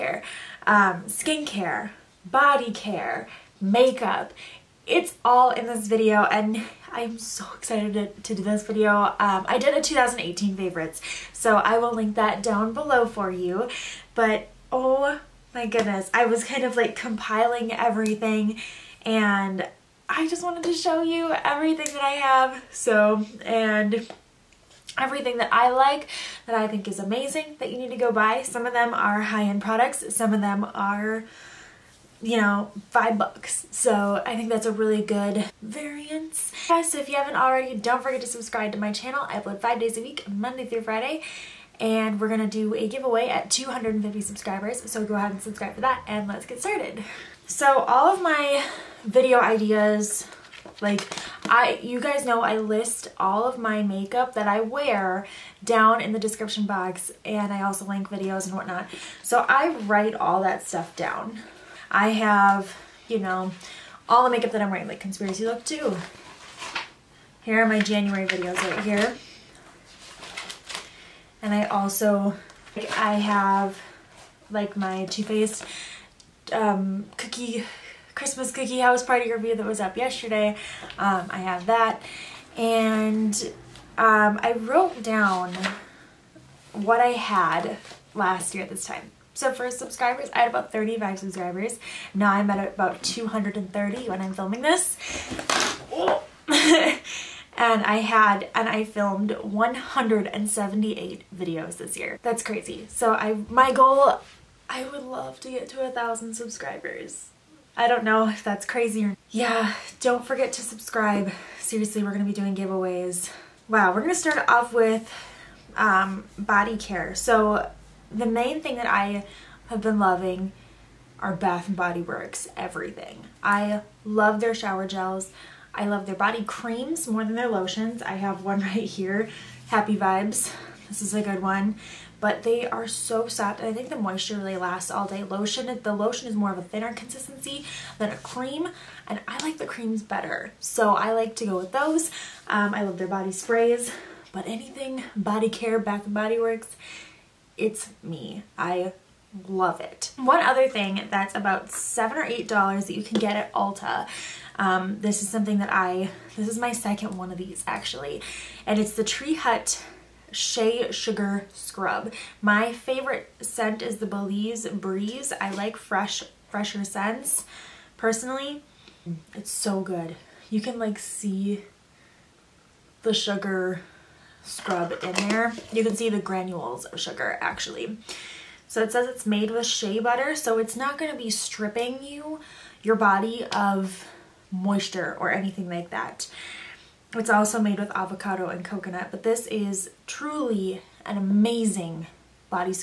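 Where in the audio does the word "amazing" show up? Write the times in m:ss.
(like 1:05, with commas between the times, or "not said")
0:26, 3:11.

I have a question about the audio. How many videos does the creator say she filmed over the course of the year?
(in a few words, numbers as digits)
178.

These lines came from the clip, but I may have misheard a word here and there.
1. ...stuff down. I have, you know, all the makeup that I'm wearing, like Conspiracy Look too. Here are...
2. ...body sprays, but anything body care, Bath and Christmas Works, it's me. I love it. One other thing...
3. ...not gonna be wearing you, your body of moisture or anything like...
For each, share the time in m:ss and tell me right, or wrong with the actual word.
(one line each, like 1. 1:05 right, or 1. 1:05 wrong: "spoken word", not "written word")
1. 1:00 right
2. 2:23 wrong: "Body", not "Christmas"
3. 3:00 wrong: "stripping", not "wearing".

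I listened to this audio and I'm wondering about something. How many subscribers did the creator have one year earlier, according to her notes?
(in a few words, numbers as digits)
35.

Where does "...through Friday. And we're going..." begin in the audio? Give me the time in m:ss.
0:40.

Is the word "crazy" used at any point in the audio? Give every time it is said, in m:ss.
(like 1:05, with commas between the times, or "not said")
1:42, 1:48.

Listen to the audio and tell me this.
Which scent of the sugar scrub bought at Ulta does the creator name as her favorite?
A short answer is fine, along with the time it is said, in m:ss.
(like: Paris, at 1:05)
Belize Breeze, at 2:44.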